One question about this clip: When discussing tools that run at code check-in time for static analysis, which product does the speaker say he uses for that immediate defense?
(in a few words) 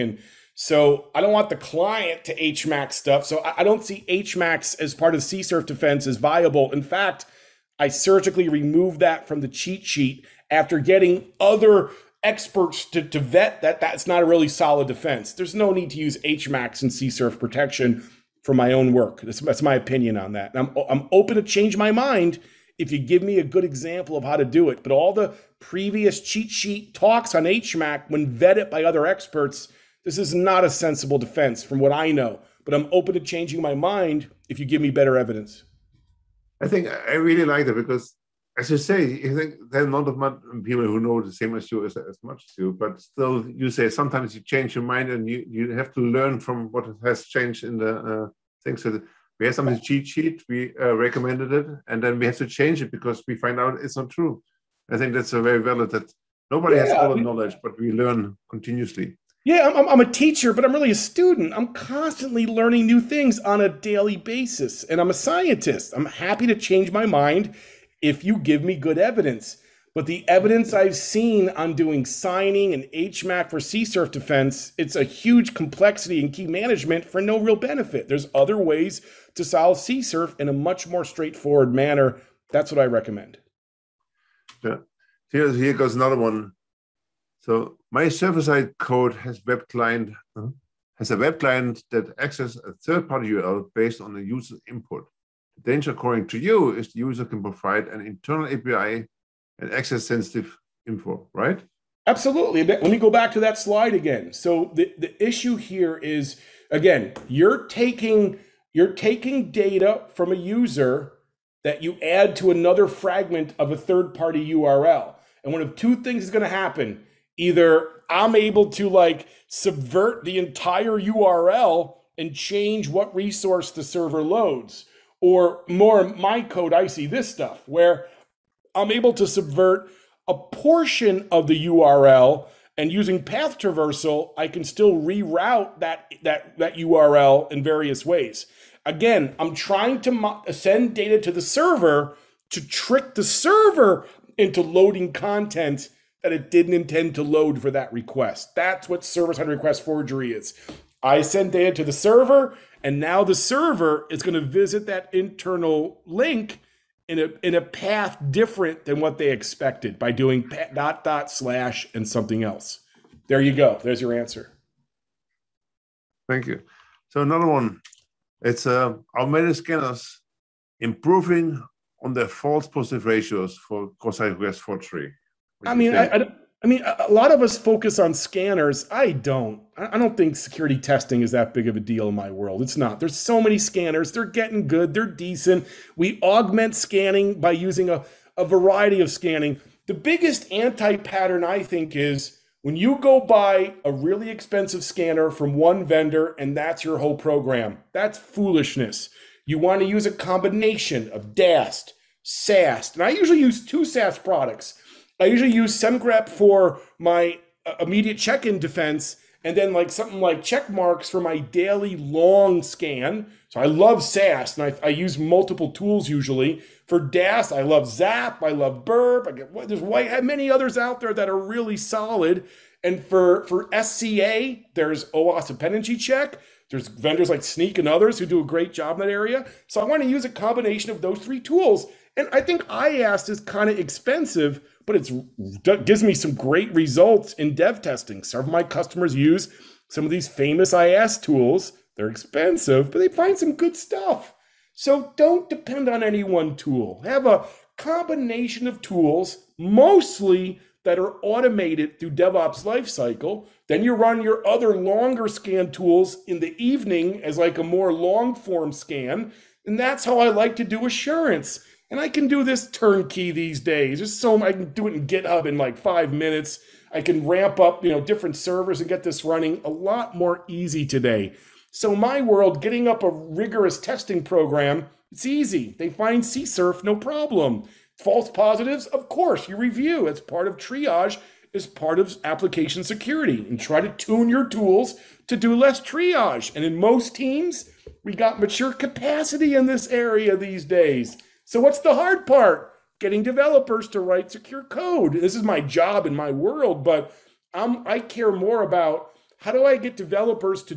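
Semgrep.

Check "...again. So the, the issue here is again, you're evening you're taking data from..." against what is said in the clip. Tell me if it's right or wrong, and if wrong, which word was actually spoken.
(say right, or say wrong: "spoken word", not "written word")
wrong: "taking", not "evening".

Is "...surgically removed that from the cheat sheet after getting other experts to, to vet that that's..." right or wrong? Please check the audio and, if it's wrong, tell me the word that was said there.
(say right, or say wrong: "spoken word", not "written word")
right.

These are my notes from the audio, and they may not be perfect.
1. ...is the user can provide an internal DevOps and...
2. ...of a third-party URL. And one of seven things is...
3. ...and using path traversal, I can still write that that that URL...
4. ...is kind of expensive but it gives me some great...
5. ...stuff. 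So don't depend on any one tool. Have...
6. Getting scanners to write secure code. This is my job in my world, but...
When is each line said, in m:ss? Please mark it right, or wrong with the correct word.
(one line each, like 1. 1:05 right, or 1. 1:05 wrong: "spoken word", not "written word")
1. 1:36 wrong: "API", not "DevOps"
2. 1:53 wrong: "two", not "seven"
3. 2:12 wrong: "reroute", not "write"
4. 3:53 right
5. 4:03 right
6. 4:52 wrong: "developers", not "scanners".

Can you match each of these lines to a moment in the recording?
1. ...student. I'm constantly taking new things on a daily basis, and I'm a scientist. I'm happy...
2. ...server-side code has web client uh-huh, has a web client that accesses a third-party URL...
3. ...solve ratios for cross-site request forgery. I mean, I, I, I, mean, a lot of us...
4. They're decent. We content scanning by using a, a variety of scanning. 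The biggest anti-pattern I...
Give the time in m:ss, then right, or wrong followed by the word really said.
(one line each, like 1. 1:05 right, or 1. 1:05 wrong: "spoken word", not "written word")
1. 1:00 wrong: "learning", not "taking"
2. 1:28 right
3. 2:52 wrong: "positive", not "solve"
4. 3:04 wrong: "augment", not "content".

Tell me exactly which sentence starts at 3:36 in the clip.
For DAST, I love Zap, I love Burp, I get, there's white, many others out there that are really solid.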